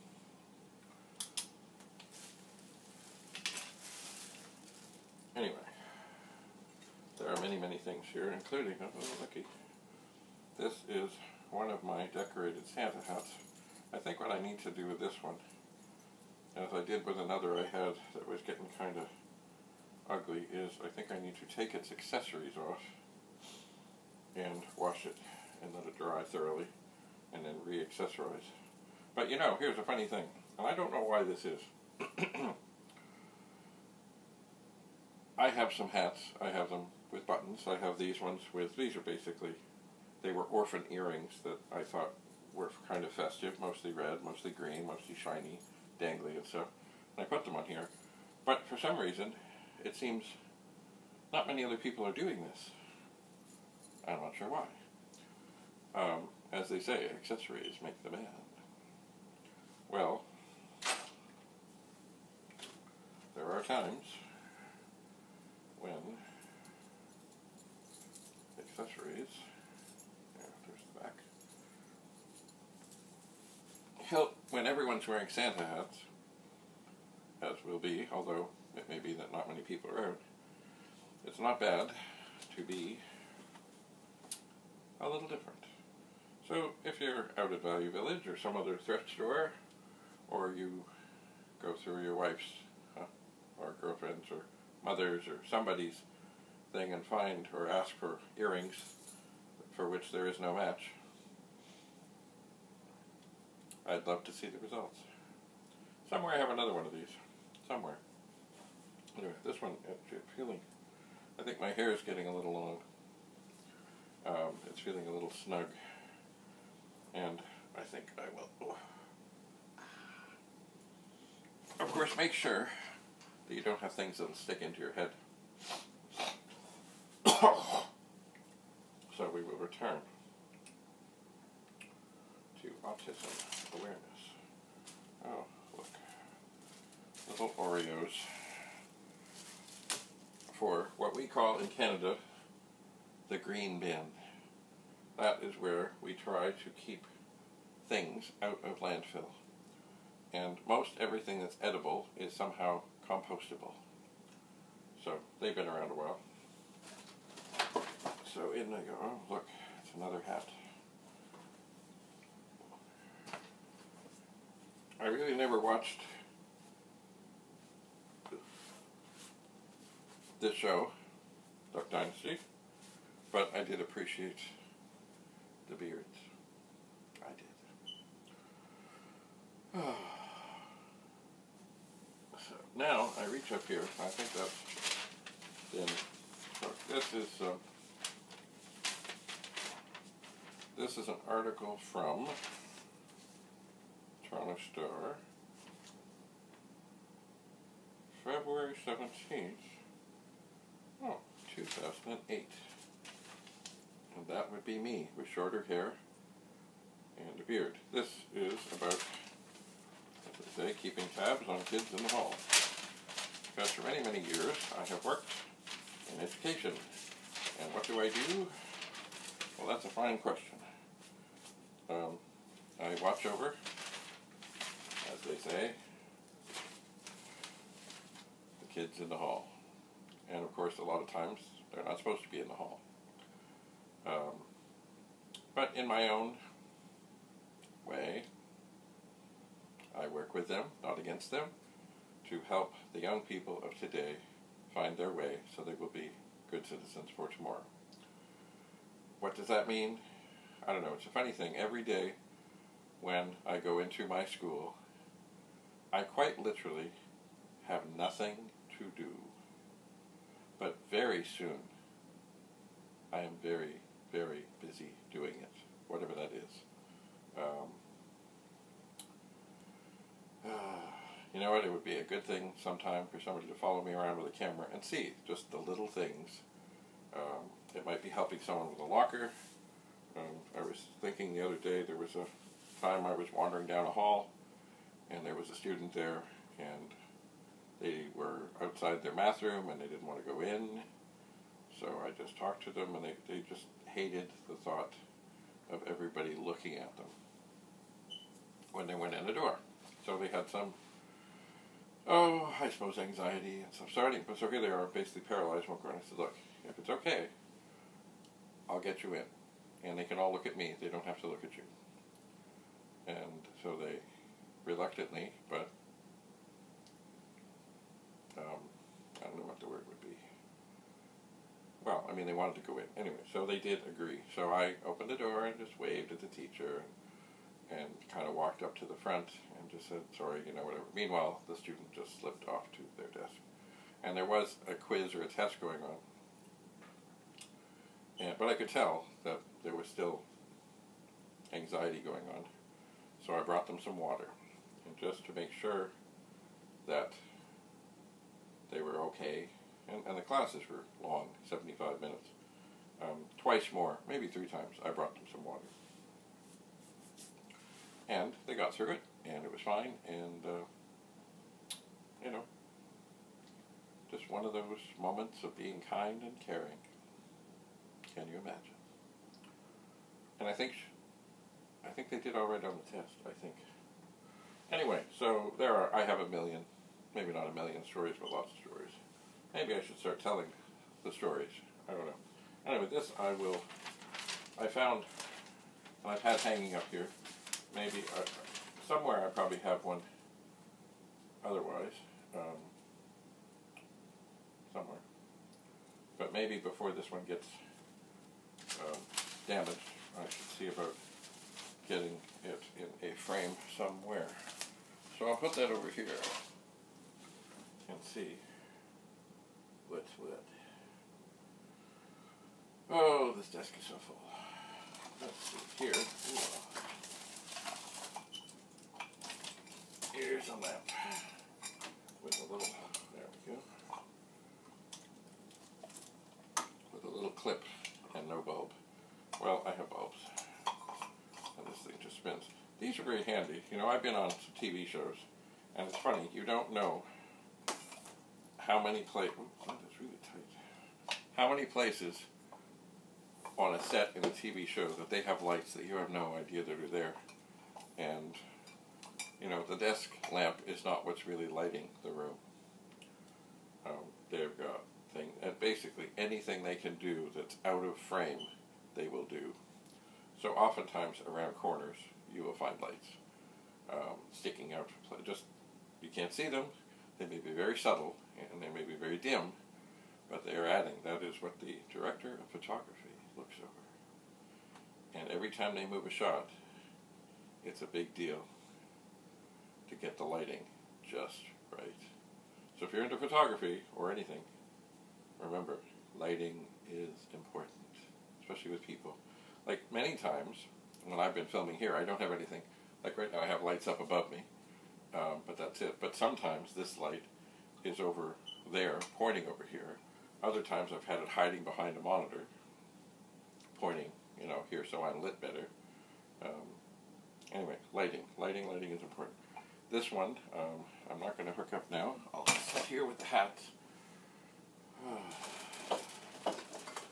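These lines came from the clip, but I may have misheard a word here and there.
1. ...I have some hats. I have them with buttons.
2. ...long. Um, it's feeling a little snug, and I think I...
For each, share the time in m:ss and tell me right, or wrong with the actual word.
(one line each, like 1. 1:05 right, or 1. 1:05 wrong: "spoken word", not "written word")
1. 0:35 right
2. 1:52 right.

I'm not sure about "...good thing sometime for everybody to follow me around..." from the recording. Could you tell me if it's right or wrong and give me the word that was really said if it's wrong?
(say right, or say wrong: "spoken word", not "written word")
wrong: "somebody", not "everybody".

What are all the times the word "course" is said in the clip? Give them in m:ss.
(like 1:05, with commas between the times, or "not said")
2:01, 3:50.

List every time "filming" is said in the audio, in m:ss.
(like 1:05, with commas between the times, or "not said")
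8:11.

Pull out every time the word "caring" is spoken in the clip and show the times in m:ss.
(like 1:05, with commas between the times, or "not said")
6:06.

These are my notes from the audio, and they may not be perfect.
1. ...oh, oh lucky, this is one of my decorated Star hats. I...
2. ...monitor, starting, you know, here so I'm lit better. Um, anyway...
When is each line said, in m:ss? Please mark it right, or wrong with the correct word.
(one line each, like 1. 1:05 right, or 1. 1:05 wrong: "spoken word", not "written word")
1. 0:08 wrong: "Santa", not "Star"
2. 8:22 wrong: "pointing", not "starting".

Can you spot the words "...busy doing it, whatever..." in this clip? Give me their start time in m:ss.
4:24.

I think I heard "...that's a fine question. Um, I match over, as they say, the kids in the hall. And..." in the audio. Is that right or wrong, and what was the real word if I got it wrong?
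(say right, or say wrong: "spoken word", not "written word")
wrong: "watch", not "match".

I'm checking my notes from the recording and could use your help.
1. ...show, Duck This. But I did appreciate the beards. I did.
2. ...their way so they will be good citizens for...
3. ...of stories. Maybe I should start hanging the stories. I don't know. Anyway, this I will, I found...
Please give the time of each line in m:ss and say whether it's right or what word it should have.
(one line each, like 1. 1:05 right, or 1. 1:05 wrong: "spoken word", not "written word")
1. 2:50 wrong: "Dynasty", not "This"
2. 4:04 right
3. 6:18 wrong: "telling", not "hanging".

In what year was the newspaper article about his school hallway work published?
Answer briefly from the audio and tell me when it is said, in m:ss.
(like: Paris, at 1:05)
2008, at 3:21.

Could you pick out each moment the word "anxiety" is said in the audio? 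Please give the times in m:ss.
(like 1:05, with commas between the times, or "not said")
5:02, 5:41.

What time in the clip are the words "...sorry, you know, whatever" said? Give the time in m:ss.
5:30.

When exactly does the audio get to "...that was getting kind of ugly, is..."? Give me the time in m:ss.
0:18.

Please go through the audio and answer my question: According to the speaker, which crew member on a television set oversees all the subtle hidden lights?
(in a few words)
director of photography.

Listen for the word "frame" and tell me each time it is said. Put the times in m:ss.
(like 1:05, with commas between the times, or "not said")
6:43, 7:37.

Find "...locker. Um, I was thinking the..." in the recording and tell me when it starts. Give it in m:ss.
4:38.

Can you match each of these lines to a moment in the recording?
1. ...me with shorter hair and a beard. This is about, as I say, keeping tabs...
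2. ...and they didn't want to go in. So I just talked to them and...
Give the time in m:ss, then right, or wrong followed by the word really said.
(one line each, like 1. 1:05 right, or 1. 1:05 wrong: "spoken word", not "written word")
1. 3:24 right
2. 4:49 right.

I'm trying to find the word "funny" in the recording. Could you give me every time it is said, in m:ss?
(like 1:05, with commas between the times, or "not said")
0:29, 4:11, 7:15.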